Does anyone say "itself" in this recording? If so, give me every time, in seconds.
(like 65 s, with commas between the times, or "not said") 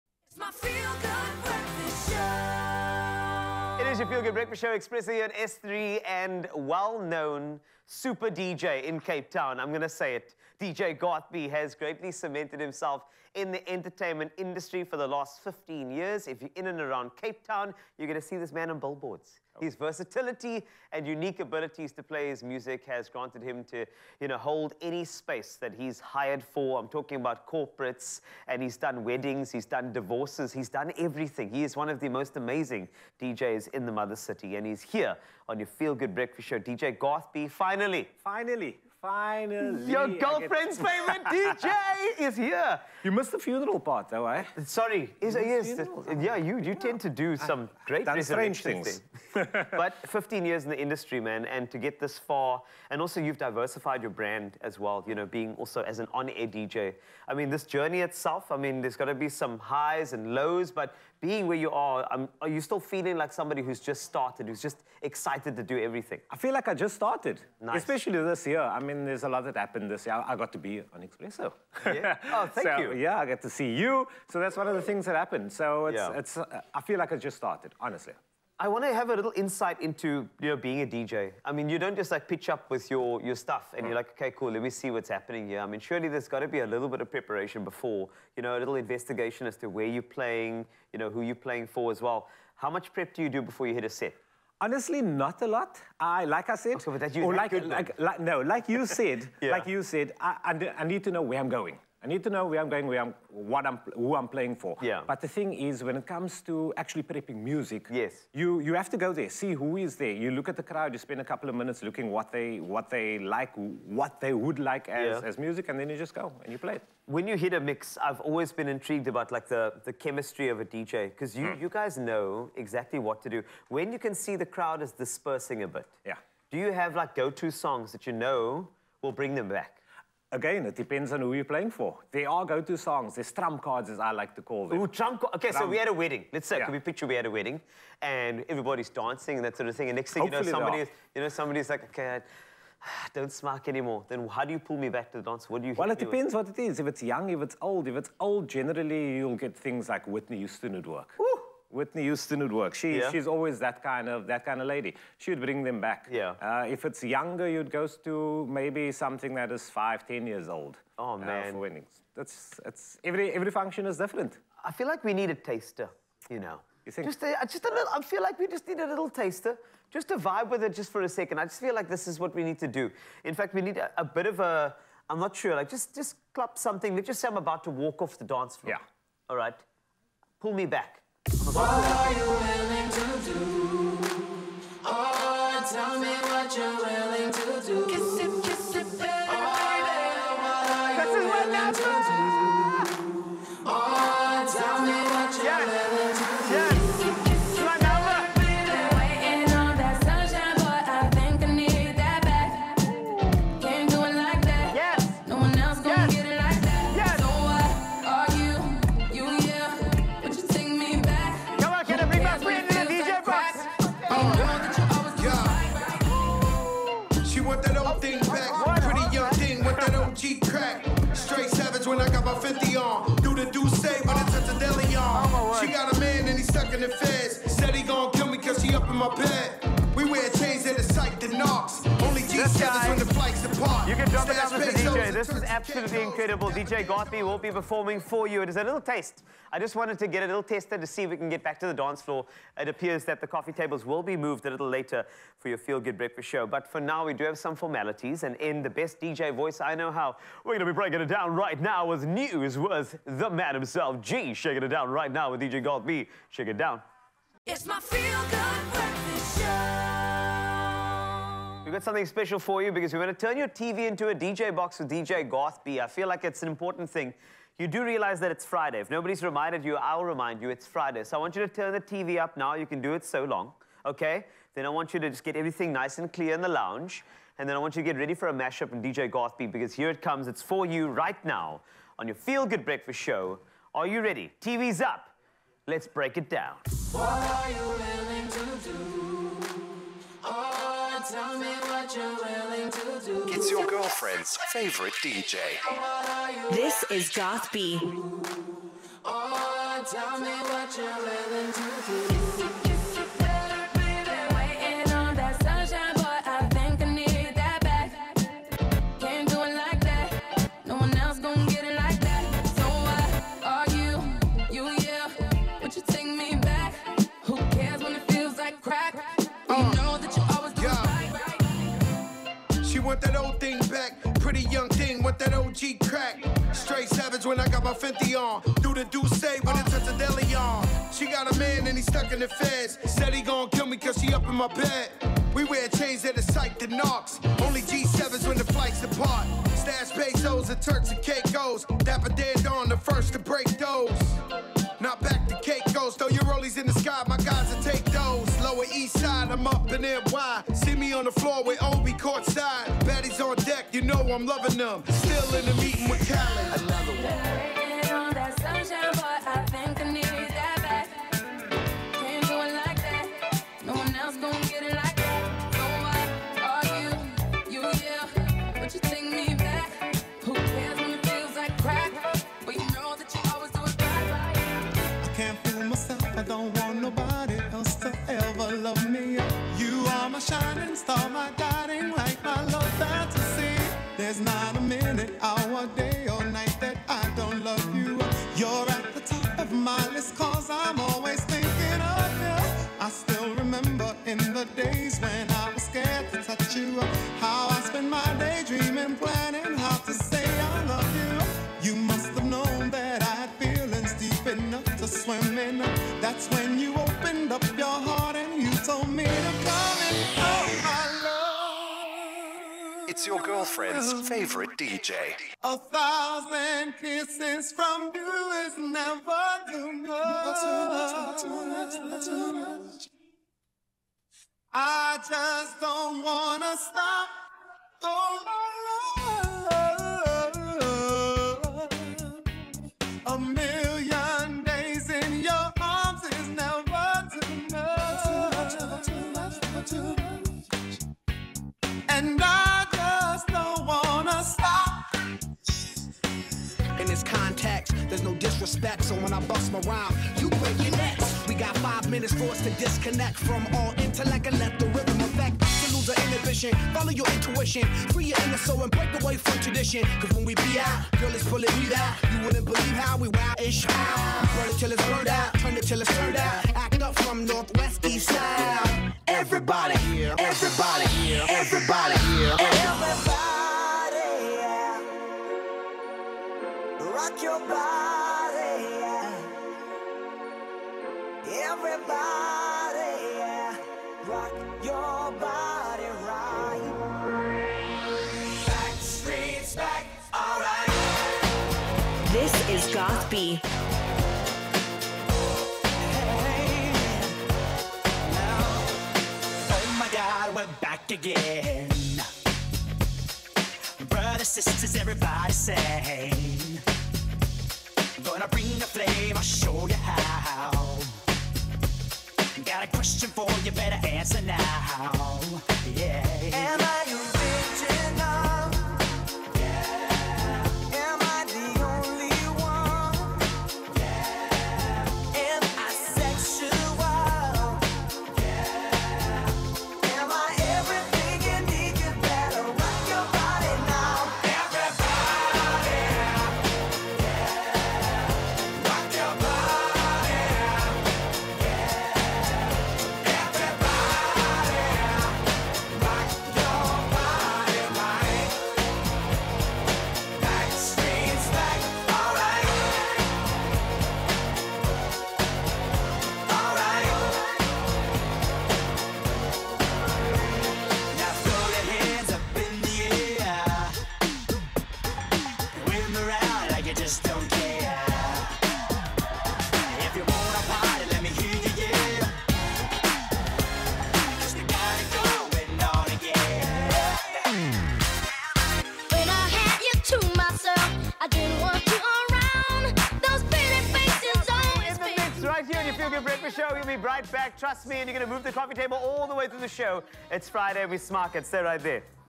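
58 s.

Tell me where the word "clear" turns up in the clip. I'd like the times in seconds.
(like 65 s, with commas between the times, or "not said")
276 s.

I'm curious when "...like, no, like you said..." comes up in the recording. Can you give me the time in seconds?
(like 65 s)
97 s.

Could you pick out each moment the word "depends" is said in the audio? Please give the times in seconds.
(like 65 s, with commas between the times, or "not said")
130 s, 145 s.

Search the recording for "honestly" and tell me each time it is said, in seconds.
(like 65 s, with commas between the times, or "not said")
77 s, 94 s.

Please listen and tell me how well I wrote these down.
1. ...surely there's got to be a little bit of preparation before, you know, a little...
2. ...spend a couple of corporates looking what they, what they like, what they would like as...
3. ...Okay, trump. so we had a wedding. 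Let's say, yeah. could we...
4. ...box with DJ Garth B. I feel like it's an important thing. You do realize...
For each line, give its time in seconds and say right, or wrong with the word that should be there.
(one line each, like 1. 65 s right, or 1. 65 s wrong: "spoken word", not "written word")
1. 85 s right
2. 110 s wrong: "minutes", not "corporates"
3. 135 s right
4. 264 s right.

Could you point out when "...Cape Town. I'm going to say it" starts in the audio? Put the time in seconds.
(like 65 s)
9 s.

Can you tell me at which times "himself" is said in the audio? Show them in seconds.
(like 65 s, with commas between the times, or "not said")
12 s, 253 s.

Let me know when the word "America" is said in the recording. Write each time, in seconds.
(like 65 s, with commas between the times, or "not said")
not said.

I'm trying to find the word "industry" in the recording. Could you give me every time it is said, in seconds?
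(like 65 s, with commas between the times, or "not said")
14 s, 50 s.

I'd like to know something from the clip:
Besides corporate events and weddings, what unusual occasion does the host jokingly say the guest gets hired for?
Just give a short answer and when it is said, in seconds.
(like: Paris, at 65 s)
divorces, at 29 s.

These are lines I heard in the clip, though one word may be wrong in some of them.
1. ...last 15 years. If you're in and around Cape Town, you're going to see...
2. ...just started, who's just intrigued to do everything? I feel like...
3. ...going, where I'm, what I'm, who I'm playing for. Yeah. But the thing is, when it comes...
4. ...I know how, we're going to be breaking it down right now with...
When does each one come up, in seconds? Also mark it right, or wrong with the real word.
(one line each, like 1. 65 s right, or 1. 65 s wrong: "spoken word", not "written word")
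1. 15 s right
2. 63 s wrong: "excited", not "intrigued"
3. 102 s right
4. 249 s right.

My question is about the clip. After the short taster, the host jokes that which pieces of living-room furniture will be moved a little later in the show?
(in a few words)
coffee tables.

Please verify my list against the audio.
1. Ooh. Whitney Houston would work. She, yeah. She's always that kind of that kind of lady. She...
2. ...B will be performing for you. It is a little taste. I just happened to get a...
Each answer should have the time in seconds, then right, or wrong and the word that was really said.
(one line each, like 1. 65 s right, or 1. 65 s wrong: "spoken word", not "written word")
1. 151 s right
2. 237 s wrong: "wanted", not "happened".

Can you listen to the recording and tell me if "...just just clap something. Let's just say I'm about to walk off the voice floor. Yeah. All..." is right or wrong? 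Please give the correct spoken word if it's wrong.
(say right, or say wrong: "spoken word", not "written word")
wrong: "dance", not "voice".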